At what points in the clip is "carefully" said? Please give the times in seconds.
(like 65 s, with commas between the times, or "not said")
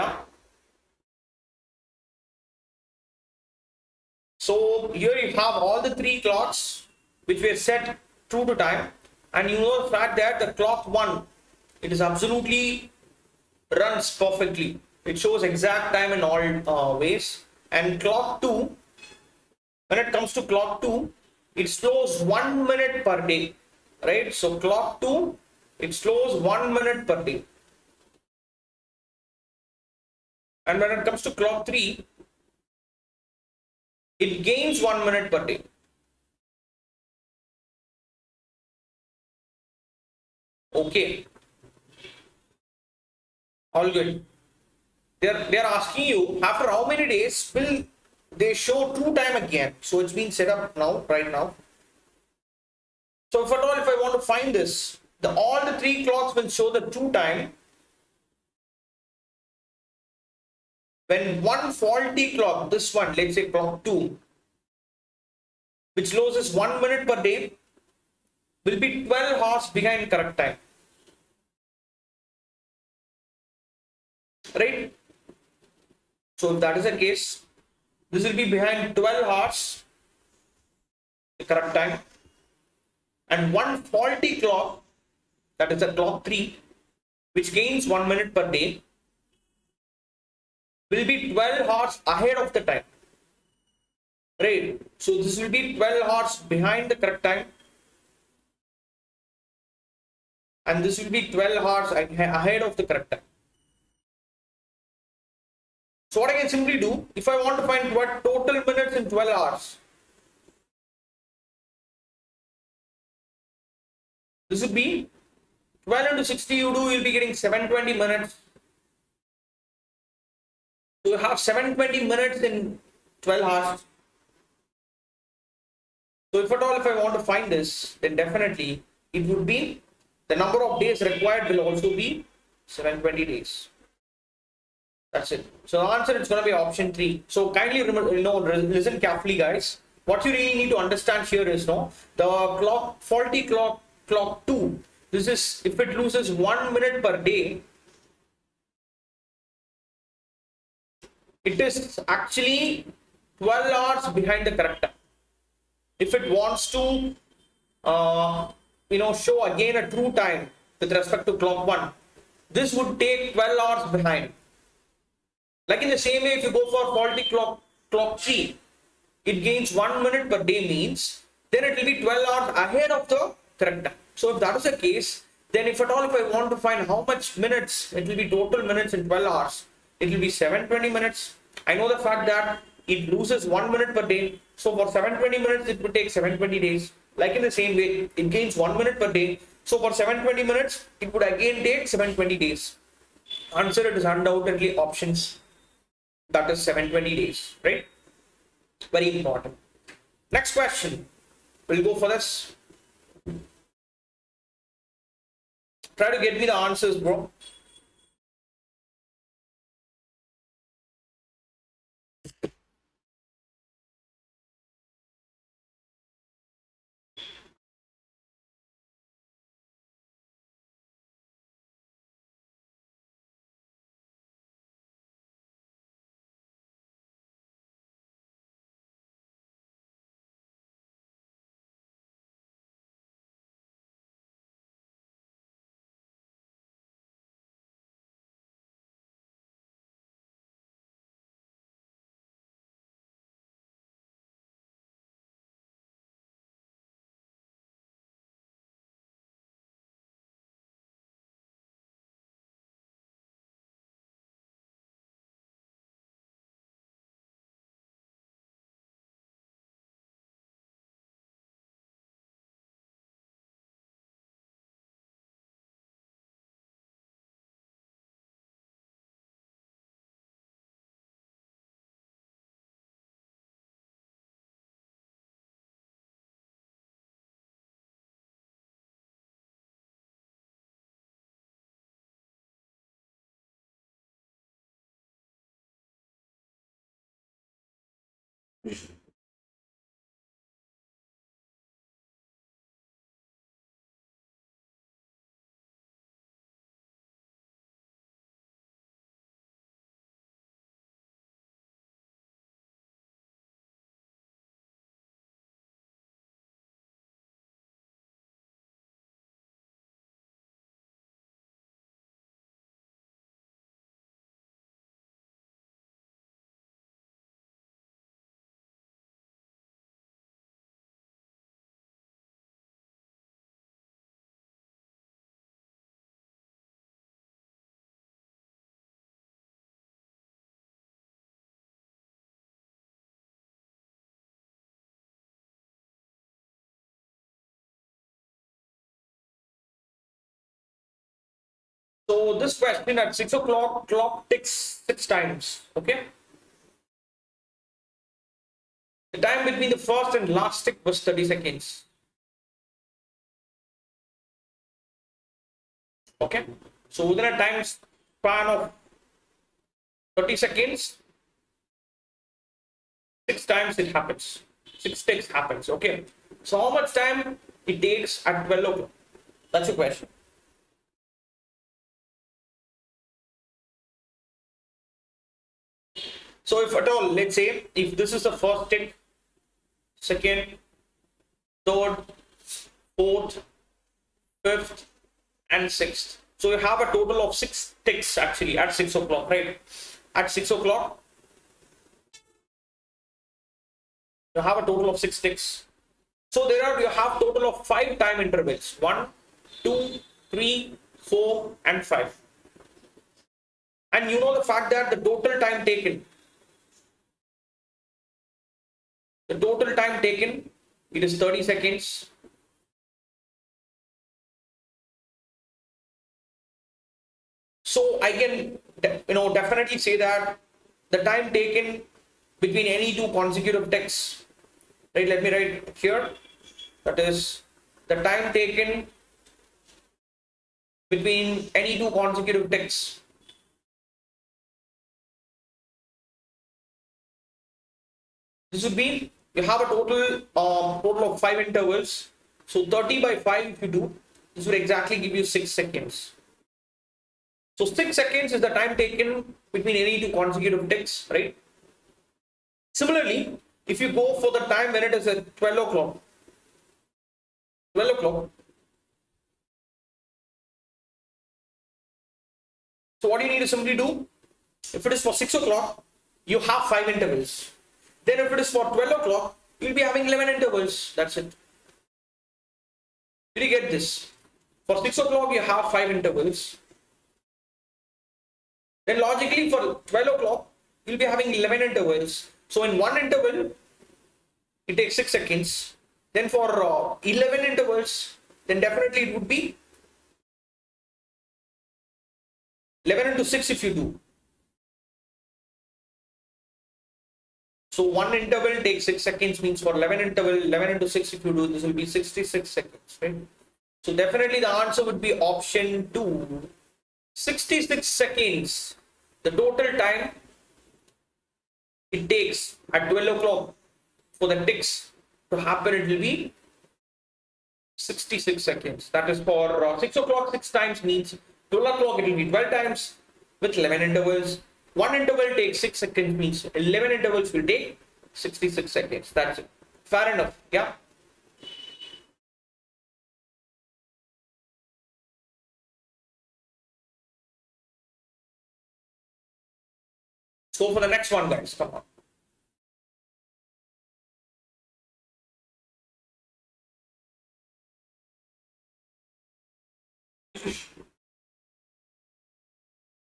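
138 s.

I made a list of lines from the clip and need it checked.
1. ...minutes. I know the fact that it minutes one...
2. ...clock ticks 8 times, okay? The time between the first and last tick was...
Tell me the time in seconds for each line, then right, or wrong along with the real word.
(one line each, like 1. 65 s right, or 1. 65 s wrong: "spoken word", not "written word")
1. 180 s wrong: "loses", not "minutes"
2. 343 s wrong: "6", not "8".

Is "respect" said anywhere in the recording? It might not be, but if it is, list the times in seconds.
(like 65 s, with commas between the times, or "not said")
160 s.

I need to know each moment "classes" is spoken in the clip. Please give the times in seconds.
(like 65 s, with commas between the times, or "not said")
not said.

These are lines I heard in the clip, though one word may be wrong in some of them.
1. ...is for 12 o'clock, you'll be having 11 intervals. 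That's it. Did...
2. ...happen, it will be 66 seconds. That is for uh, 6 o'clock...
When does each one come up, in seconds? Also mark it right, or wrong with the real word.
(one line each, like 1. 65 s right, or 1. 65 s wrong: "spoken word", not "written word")
1. 468 s right
2. 515 s right.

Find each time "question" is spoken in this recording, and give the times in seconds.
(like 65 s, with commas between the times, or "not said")
200 s, 342 s, 369 s.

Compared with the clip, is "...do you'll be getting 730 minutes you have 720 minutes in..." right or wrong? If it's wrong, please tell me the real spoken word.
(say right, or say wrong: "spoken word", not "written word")
wrong: "720", not "730".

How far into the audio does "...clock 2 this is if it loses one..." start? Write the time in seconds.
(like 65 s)
144 s.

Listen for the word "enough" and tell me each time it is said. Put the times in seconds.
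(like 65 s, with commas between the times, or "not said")
530 s.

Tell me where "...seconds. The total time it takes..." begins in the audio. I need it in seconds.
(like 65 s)
507 s.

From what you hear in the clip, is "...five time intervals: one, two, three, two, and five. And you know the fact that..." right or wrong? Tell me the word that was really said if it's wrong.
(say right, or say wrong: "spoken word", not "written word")
wrong: "four", not "two".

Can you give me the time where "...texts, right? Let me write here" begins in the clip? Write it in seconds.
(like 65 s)
423 s.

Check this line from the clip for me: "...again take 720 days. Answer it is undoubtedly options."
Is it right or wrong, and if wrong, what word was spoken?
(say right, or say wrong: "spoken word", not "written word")
right.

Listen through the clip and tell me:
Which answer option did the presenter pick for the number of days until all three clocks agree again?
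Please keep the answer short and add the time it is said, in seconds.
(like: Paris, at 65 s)
Option 3, at 136 s.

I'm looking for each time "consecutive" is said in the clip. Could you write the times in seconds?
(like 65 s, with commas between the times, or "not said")
423 s, 431 s, 450 s.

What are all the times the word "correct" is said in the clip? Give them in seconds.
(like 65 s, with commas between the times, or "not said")
70 s, 81 s, 97 s, 102 s, 154 s, 173 s.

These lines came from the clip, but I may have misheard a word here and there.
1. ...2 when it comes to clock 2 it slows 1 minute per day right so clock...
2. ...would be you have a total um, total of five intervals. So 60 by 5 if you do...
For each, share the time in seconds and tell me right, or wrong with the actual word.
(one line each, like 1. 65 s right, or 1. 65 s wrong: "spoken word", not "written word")
1. 18 s right
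2. 438 s wrong: "30", not "60".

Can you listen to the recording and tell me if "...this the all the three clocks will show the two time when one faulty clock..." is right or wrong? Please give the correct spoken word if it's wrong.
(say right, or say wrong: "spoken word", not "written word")
right.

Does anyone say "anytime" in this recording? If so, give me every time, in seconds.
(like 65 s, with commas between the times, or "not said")
not said.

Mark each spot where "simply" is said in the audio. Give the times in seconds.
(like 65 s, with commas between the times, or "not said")
106 s, 463 s.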